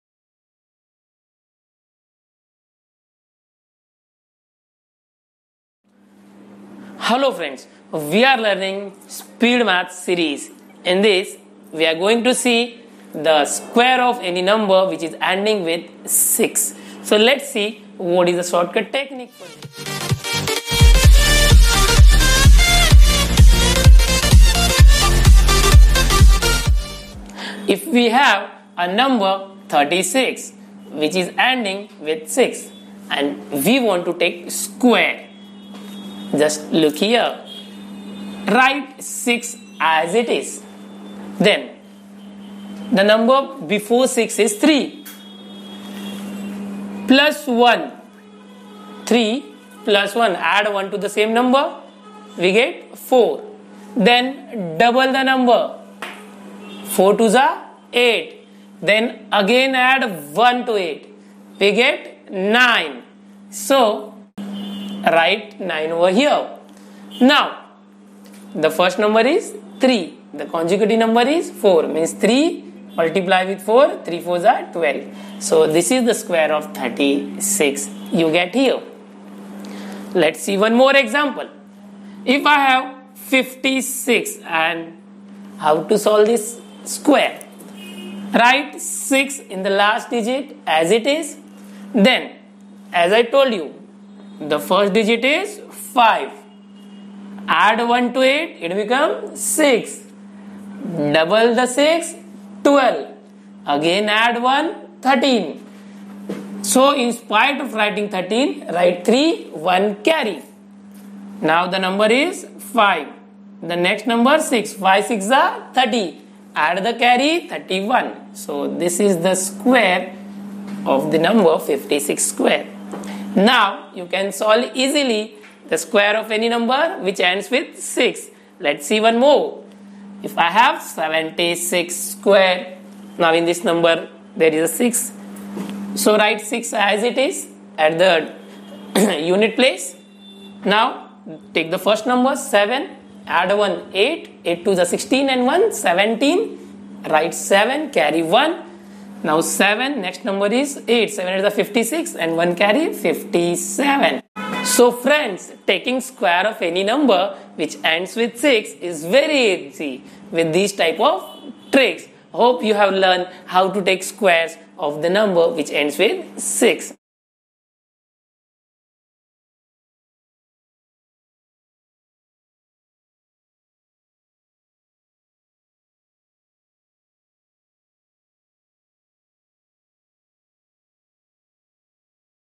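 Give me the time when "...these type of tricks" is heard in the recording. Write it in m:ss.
2:40.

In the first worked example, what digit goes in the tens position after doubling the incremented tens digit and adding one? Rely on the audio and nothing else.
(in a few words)
9.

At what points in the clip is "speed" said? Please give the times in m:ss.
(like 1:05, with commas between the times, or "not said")
0:09.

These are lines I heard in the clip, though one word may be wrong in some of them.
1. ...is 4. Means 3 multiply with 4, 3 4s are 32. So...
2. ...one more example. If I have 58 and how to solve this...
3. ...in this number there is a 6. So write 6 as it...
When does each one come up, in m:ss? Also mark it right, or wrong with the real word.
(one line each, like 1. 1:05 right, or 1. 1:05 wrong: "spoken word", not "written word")
1. 1:11 wrong: "12", not "32"
2. 1:20 wrong: "56", not "58"
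3. 2:13 right.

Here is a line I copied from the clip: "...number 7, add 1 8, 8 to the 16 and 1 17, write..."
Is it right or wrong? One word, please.
right.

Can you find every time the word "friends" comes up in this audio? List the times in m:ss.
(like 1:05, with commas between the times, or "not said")
0:07, 2:34.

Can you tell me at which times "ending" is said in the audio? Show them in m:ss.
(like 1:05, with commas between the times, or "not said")
0:15, 0:31.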